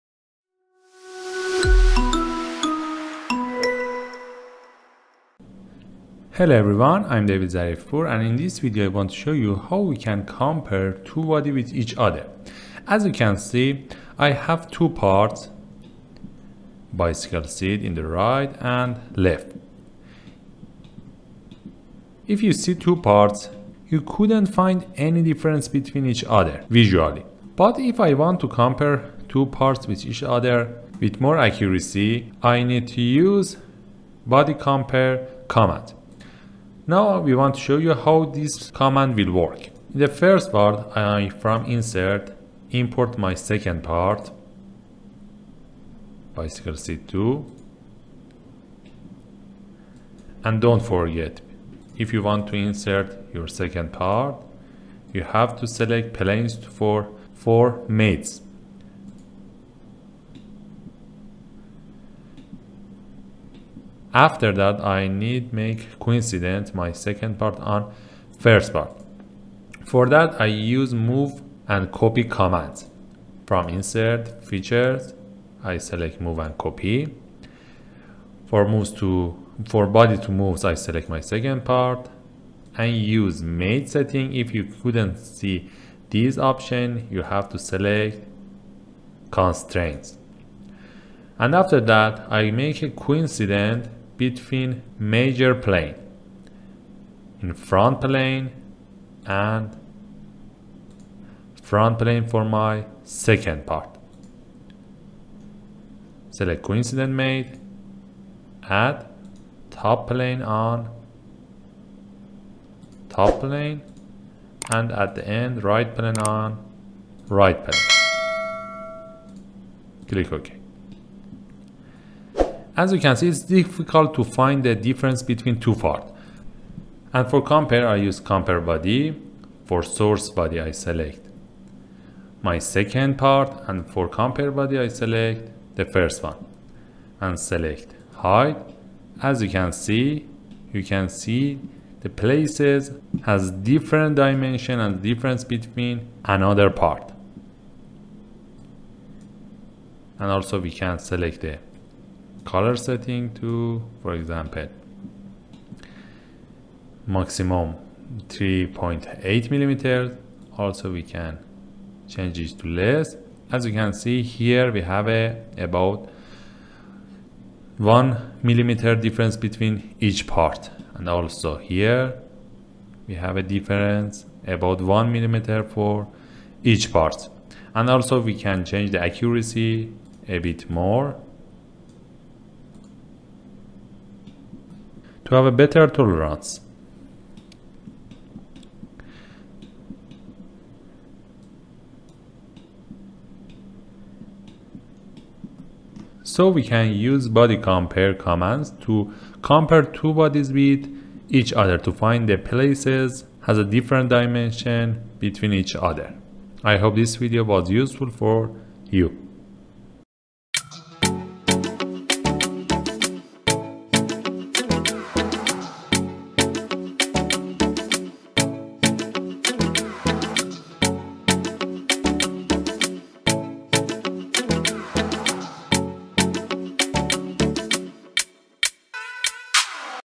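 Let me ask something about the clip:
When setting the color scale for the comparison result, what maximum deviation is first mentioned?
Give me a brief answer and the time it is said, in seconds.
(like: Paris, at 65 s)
3.8 millimeters, at 158 s.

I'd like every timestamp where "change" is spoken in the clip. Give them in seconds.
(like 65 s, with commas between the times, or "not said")
162 s, 178 s.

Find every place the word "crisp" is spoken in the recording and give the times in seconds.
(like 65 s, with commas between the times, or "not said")
not said.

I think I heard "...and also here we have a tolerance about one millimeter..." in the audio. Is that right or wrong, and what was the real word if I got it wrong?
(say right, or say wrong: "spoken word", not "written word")
wrong: "difference", not "tolerance".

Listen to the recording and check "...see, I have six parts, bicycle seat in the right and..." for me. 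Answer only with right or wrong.
wrong.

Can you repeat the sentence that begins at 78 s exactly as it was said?
For moves to for body to moves, I select my second part and use mate setting.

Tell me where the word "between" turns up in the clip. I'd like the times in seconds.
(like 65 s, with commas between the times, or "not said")
25 s, 94 s, 125 s, 145 s, 169 s, 205 s.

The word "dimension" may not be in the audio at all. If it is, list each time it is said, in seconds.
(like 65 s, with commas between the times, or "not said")
144 s, 204 s.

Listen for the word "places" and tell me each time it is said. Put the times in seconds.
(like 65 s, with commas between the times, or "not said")
142 s, 202 s.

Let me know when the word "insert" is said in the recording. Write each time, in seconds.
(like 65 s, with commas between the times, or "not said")
41 s, 52 s, 73 s.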